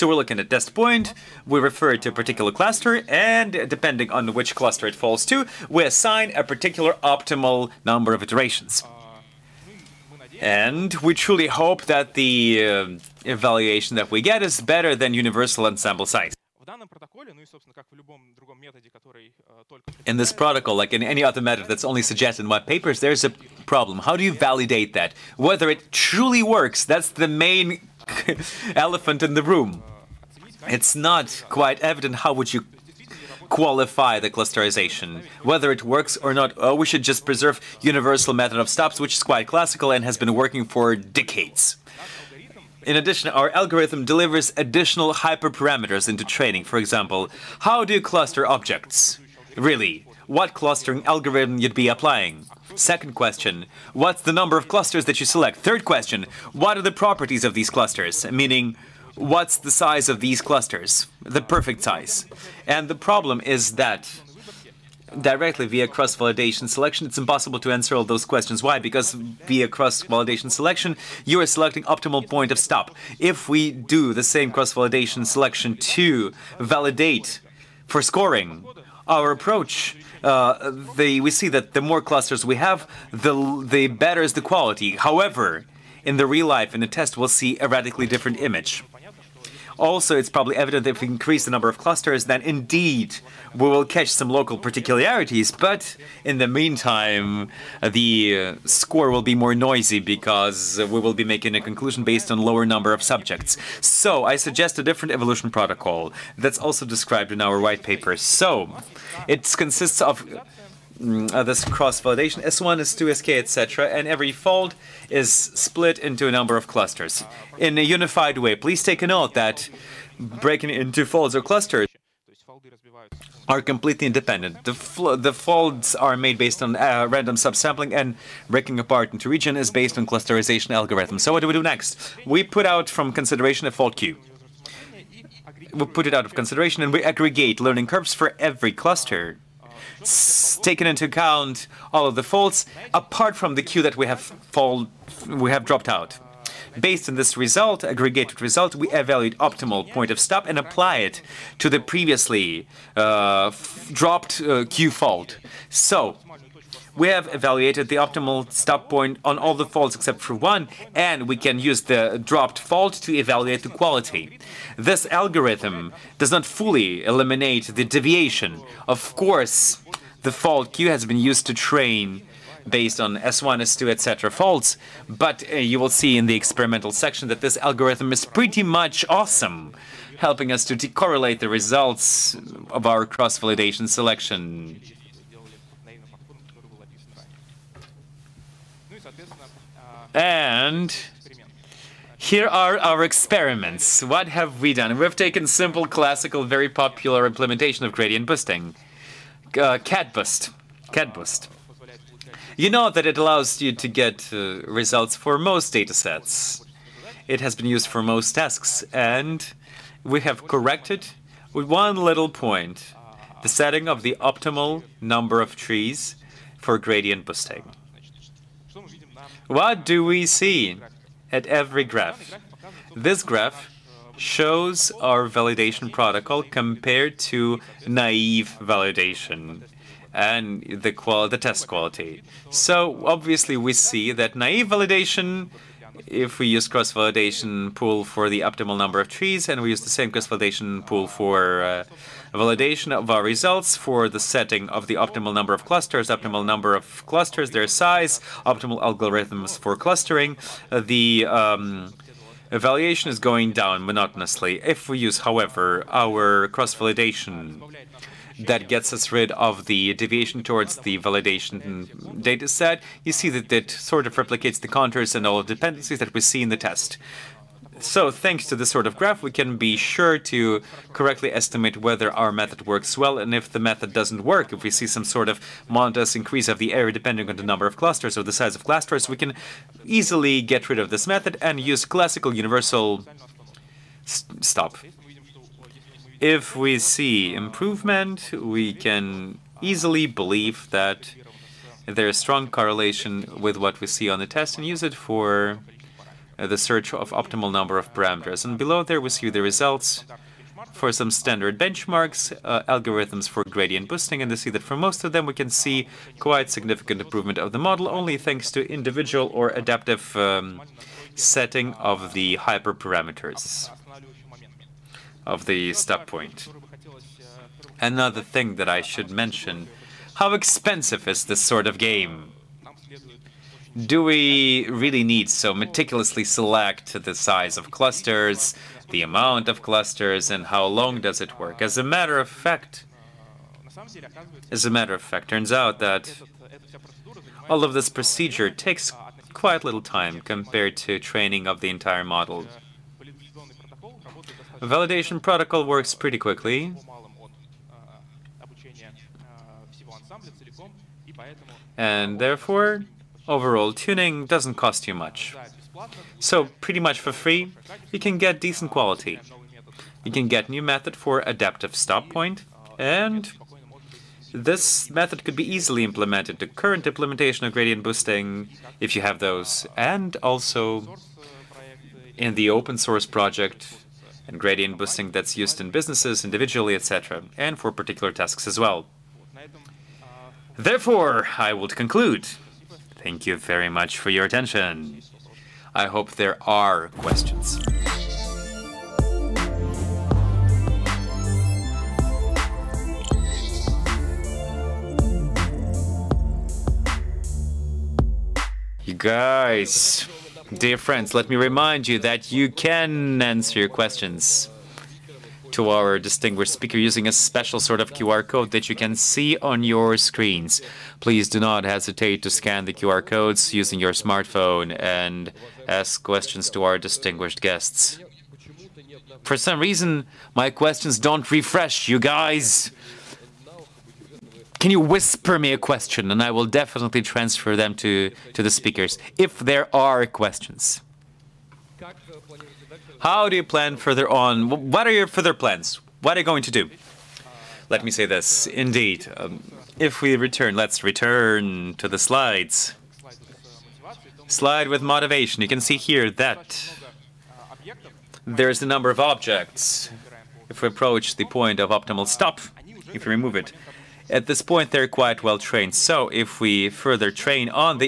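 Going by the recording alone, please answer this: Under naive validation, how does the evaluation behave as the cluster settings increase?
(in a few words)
Going down monotonously.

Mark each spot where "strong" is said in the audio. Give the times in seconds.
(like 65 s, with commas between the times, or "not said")
292 s.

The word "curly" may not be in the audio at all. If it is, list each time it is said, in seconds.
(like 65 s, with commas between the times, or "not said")
not said.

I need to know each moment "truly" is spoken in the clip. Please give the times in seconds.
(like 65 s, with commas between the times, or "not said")
11 s, 25 s.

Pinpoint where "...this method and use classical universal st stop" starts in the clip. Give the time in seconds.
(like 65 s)
280 s.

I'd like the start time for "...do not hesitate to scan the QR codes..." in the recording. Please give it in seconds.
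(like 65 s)
411 s.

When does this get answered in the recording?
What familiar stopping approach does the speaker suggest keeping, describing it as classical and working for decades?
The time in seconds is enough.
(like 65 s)
37 s.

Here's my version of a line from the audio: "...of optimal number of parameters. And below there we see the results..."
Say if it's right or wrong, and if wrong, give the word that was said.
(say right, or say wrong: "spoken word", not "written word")
right.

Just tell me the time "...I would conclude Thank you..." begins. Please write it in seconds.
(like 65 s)
381 s.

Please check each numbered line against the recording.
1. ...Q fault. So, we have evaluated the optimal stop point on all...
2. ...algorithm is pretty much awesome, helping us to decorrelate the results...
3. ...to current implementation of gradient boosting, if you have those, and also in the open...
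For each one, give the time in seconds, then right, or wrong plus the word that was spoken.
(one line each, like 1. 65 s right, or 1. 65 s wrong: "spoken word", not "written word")
1. 154 s right
2. 177 s right
3. 366 s right.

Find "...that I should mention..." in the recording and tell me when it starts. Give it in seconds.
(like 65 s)
318 s.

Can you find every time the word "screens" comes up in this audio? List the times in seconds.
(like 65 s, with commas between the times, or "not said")
409 s.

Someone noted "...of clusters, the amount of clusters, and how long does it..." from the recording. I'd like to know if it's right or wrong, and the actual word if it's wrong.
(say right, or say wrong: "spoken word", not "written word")
right.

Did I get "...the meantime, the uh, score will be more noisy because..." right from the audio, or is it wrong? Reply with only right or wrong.
right.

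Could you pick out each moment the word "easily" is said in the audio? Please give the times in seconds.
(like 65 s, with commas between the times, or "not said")
279 s, 289 s, 365 s.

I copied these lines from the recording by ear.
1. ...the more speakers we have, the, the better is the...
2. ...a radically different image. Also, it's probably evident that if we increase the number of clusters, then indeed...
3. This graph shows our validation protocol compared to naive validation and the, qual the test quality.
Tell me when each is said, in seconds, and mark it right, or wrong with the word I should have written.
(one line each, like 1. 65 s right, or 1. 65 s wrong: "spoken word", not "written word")
1. 81 s wrong: "clusters", not "speakers"
2. 87 s right
3. 222 s right.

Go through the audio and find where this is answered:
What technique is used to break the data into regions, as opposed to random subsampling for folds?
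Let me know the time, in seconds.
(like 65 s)
130 s.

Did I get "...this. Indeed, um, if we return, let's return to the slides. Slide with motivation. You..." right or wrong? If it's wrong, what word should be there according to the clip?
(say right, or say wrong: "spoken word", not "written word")
right.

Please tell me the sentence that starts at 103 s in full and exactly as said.
So I suggest a different evolution protocol that's also described in our white paper.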